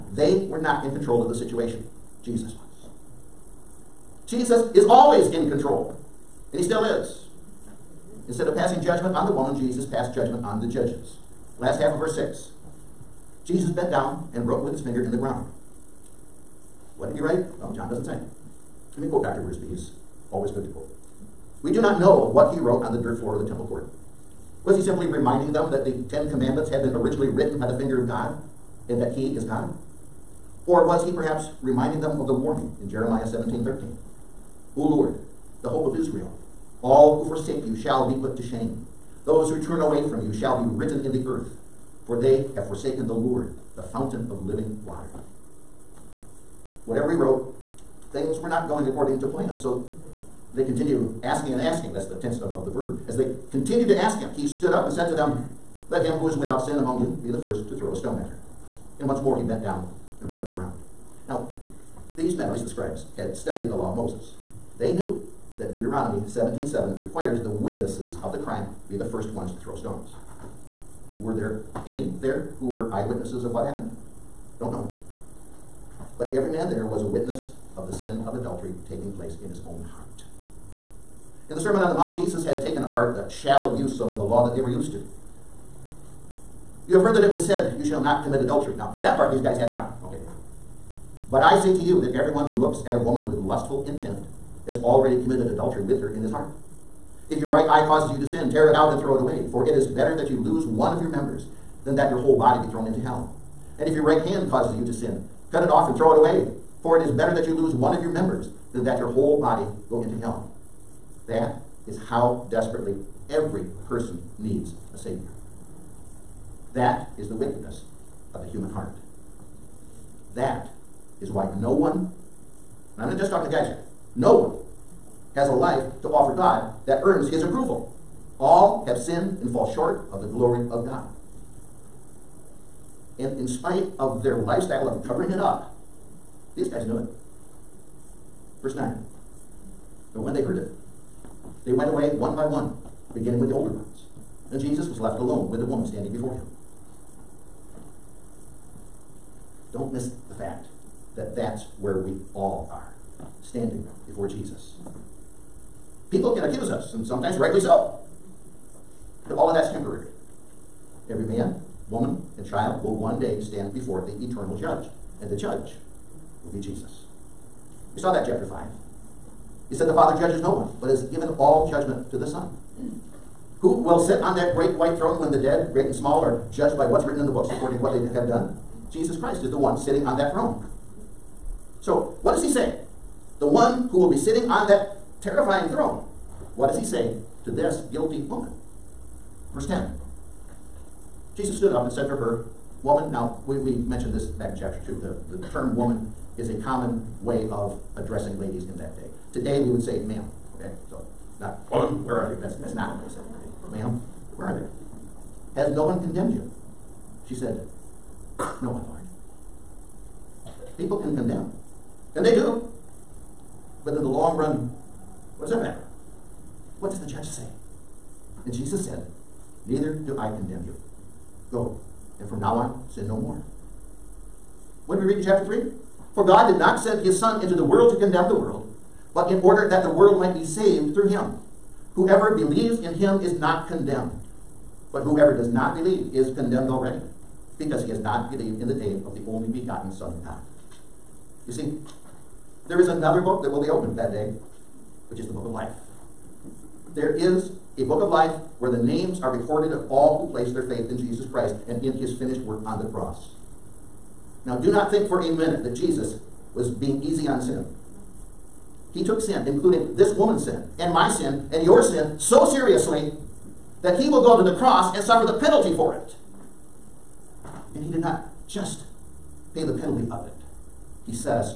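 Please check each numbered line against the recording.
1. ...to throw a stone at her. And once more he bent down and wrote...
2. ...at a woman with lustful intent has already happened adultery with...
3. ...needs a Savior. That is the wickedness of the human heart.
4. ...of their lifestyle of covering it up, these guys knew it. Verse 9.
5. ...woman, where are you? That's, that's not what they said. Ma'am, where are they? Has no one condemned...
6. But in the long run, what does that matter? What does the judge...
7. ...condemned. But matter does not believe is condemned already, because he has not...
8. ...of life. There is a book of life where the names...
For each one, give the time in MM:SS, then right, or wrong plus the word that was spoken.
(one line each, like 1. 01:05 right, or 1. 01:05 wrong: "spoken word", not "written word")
1. 00:57 right
2. 01:32 wrong: "committed", not "happened"
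3. 01:54 right
4. 02:13 right
5. 03:21 right
6. 03:33 right
7. 03:53 wrong: "whoever", not "matter"
8. 04:05 right.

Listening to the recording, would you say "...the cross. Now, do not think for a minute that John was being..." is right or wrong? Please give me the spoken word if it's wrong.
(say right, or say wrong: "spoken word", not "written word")
wrong: "Jesus", not "John".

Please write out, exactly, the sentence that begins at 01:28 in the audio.
Now, that part these guys had down.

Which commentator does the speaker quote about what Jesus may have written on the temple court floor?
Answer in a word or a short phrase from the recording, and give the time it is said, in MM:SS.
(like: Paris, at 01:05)
Dr. Wiersbe, at 00:19.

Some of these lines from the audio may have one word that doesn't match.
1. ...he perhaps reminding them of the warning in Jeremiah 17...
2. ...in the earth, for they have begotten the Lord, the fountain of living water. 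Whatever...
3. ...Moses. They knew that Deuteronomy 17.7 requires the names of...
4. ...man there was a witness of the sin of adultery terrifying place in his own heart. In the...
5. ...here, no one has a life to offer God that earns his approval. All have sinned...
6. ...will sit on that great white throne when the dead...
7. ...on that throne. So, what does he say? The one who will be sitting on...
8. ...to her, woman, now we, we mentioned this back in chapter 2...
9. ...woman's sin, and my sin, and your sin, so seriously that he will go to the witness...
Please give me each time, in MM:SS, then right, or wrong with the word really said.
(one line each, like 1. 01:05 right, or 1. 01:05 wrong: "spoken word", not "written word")
1. 00:31 right
2. 00:41 wrong: "forsaken", not "begotten"
3. 01:03 wrong: "witnesses", not "names"
4. 01:16 wrong: "taking", not "terrifying"
5. 02:03 right
6. 02:53 right
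7. 03:00 right
8. 03:12 right
9. 04:20 wrong: "cross", not "witness".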